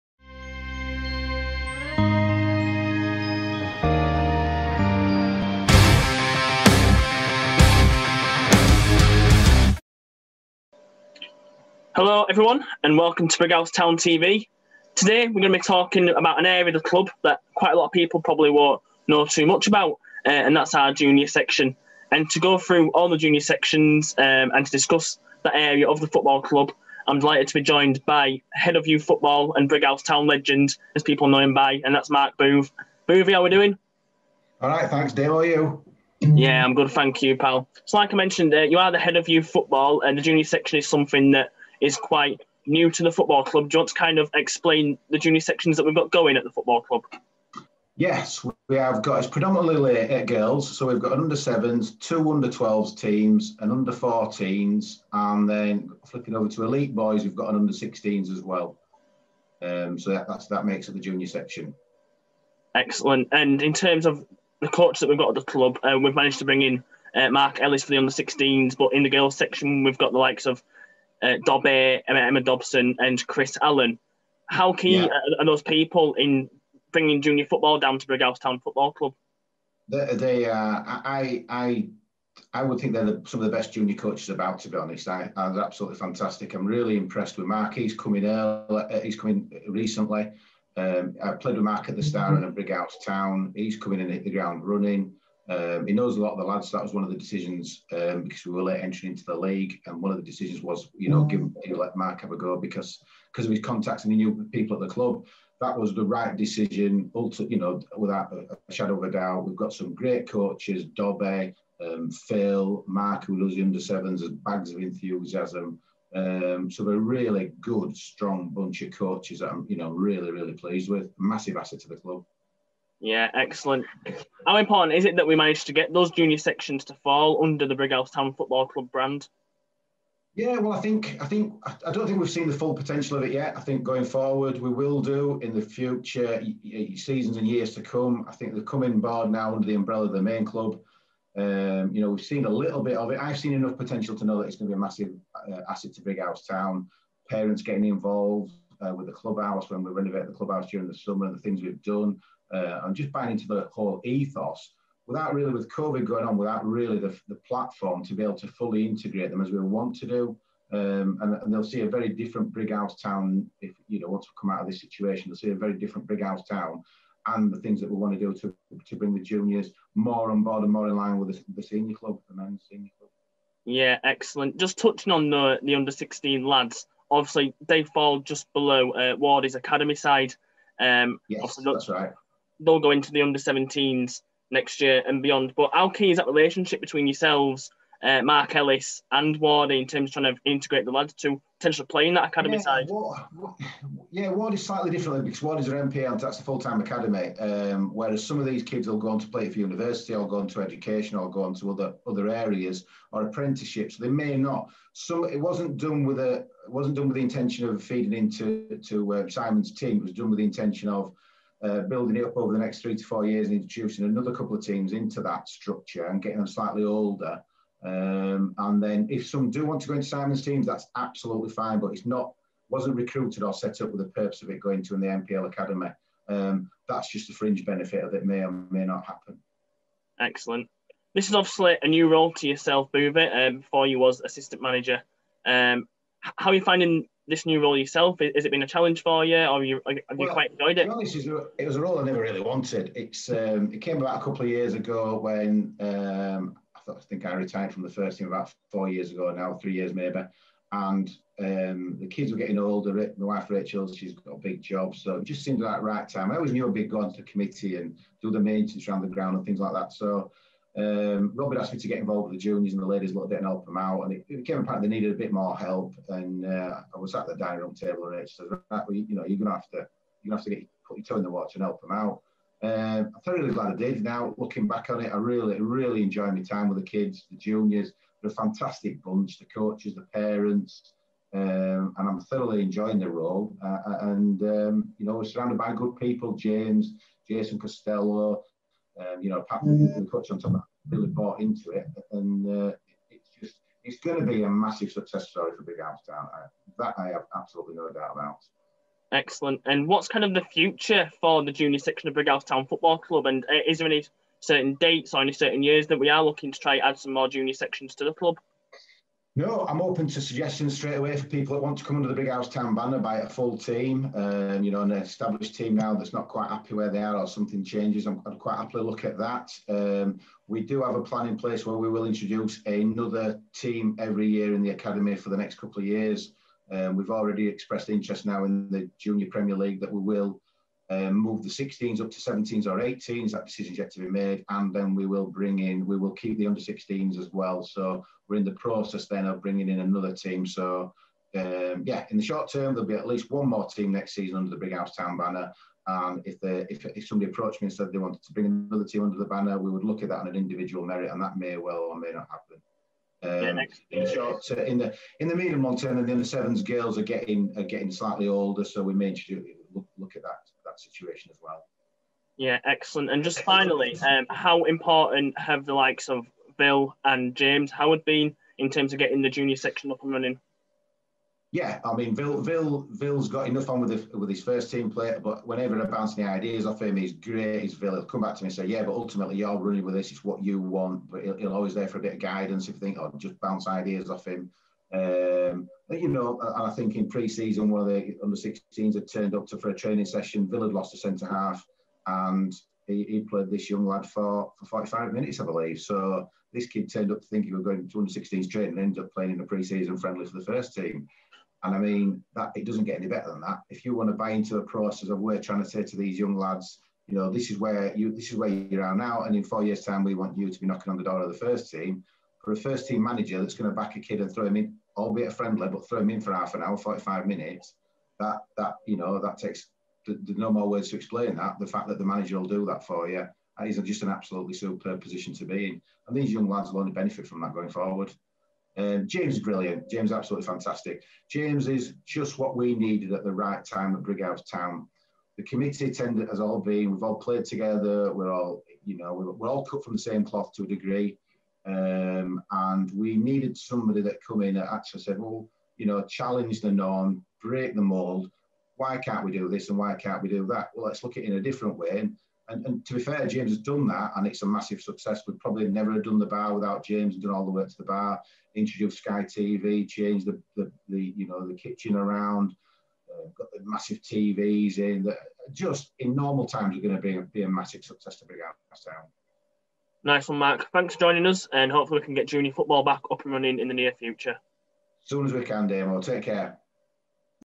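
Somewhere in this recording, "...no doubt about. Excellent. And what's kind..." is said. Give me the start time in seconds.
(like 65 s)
297 s.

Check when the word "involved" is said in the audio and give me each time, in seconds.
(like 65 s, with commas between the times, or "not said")
147 s, 261 s.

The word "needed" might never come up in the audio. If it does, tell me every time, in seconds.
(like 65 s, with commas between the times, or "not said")
264 s, 432 s, 443 s.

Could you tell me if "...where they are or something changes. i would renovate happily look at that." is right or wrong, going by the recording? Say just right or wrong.
wrong.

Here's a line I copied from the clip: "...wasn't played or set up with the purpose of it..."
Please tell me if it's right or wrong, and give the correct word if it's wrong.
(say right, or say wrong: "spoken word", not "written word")
wrong: "recruited", not "played".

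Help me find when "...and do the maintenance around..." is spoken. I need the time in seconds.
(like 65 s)
257 s.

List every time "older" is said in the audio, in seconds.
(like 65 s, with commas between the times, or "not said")
216 s, 252 s, 358 s.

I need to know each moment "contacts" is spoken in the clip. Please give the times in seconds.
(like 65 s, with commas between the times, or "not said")
103 s.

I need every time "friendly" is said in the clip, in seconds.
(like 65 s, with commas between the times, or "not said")
399 s, 415 s.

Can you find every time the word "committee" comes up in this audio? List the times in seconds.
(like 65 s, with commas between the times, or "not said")
257 s, 435 s.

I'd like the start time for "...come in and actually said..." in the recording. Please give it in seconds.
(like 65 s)
444 s.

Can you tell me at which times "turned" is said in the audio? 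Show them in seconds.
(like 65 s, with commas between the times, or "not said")
389 s, 396 s.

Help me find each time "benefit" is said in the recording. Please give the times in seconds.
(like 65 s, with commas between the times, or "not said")
227 s, 426 s.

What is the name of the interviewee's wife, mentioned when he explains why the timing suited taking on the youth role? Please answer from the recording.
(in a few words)
Rachel.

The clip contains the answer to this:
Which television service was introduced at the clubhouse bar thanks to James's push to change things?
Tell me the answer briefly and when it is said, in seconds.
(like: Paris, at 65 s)
Sky TV, at 458 s.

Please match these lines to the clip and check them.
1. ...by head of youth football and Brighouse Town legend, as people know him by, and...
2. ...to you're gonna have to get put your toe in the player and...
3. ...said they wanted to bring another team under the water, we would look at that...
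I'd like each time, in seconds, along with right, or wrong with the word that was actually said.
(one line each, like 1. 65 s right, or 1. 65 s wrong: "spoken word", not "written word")
1. 28 s right
2. 269 s wrong: "water", not "player"
3. 347 s wrong: "banner", not "water".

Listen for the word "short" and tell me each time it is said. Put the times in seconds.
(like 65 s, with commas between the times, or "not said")
342 s, 354 s.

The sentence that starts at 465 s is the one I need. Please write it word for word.
That just in normal times, are going to be a, be a massive success to Brighouse Nice one, Mark.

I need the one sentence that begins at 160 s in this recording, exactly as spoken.
Um, and, and, they'll see a very different Brighouse town if you know once we come out of this situation.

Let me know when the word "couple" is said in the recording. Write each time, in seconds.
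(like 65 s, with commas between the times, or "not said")
214 s, 244 s, 325 s.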